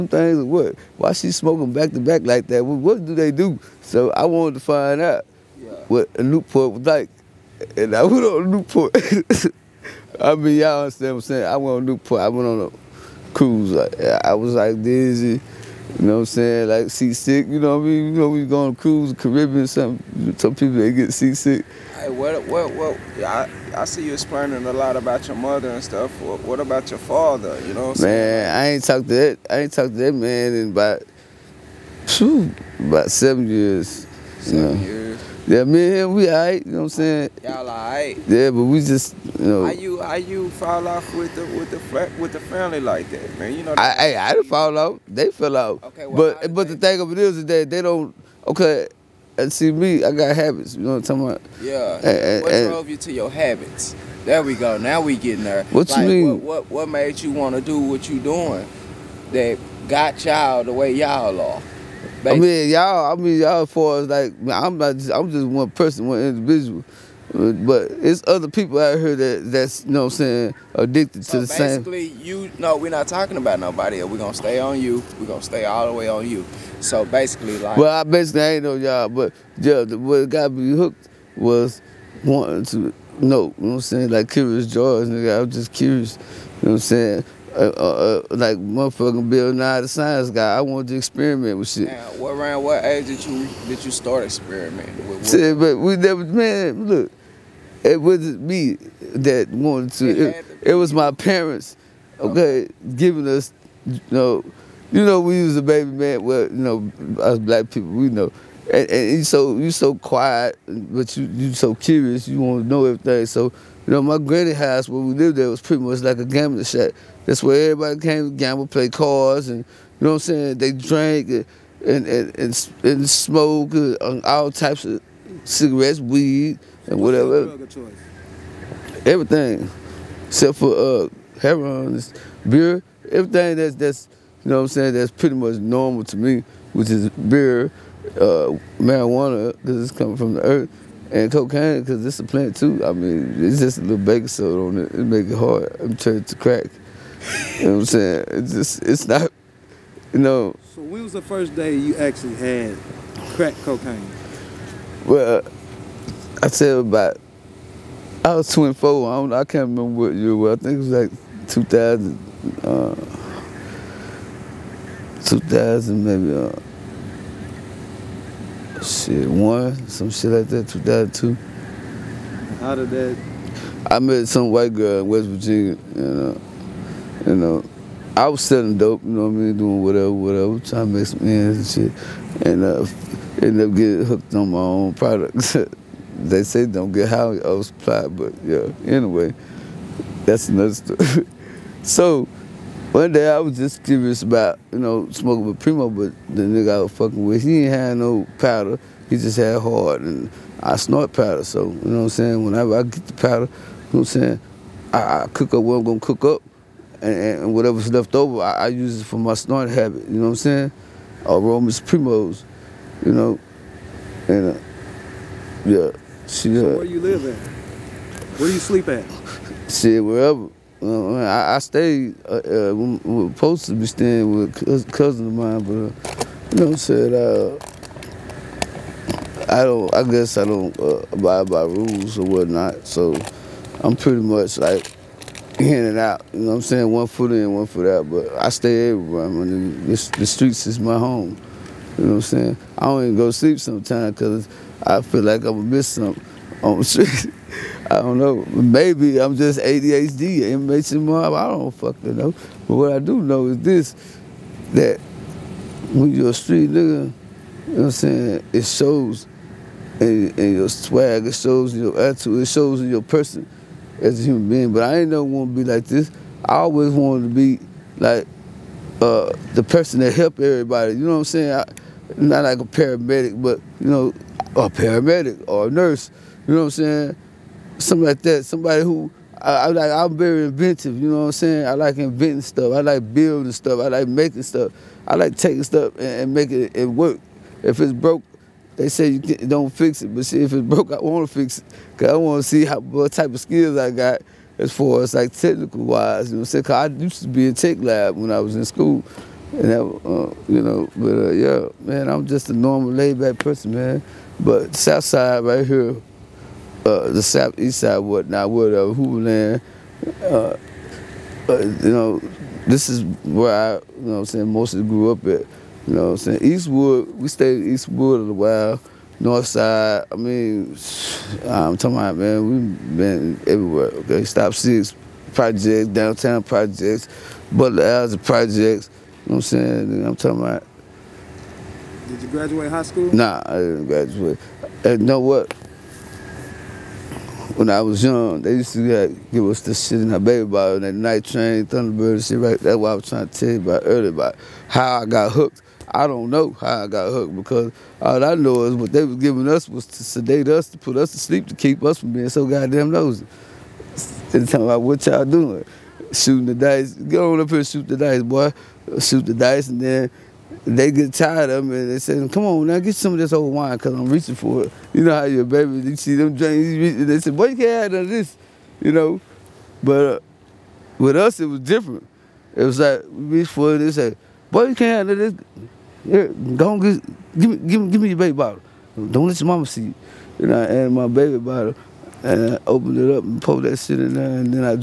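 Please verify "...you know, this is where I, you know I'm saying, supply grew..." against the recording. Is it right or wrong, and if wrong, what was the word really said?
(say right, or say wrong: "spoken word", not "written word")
wrong: "mostly", not "supply".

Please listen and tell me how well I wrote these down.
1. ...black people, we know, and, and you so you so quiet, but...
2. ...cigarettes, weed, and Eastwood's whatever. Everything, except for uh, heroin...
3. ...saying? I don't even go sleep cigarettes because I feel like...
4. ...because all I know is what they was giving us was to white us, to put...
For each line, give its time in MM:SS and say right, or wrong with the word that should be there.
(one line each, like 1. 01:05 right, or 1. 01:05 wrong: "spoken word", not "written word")
1. 01:47 right
2. 02:05 wrong: "What", not "Eastwood"
3. 04:02 wrong: "sometimes", not "cigarettes"
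4. 05:47 wrong: "sedate", not "white".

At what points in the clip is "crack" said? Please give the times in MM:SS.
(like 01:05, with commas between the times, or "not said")
02:26, 02:33.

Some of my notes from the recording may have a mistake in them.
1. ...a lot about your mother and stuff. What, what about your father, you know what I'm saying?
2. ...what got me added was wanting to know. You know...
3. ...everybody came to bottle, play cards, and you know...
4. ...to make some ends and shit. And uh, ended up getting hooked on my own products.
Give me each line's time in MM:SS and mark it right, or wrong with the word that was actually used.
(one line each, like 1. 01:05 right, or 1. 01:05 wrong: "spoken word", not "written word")
1. 00:24 right
2. 01:19 wrong: "hooked", not "added"
3. 01:57 wrong: "gamble", not "bottle"
4. 03:00 right.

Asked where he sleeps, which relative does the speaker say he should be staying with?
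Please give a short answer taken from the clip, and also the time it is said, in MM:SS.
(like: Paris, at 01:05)
Cousin, at 03:44.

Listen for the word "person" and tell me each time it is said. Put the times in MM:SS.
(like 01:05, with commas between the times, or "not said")
01:05, 04:23, 04:29, 05:03.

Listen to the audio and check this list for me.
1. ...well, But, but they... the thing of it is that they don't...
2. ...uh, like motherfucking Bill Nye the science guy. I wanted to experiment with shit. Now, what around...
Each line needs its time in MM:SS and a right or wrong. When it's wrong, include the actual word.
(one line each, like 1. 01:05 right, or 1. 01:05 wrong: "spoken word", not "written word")
1. 00:46 right
2. 01:28 right.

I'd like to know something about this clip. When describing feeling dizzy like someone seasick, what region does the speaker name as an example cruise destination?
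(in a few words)
Caribbean.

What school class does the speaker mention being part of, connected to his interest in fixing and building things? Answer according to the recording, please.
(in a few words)
Tech lab.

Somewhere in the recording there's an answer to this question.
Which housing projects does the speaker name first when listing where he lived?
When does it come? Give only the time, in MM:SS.
05:24.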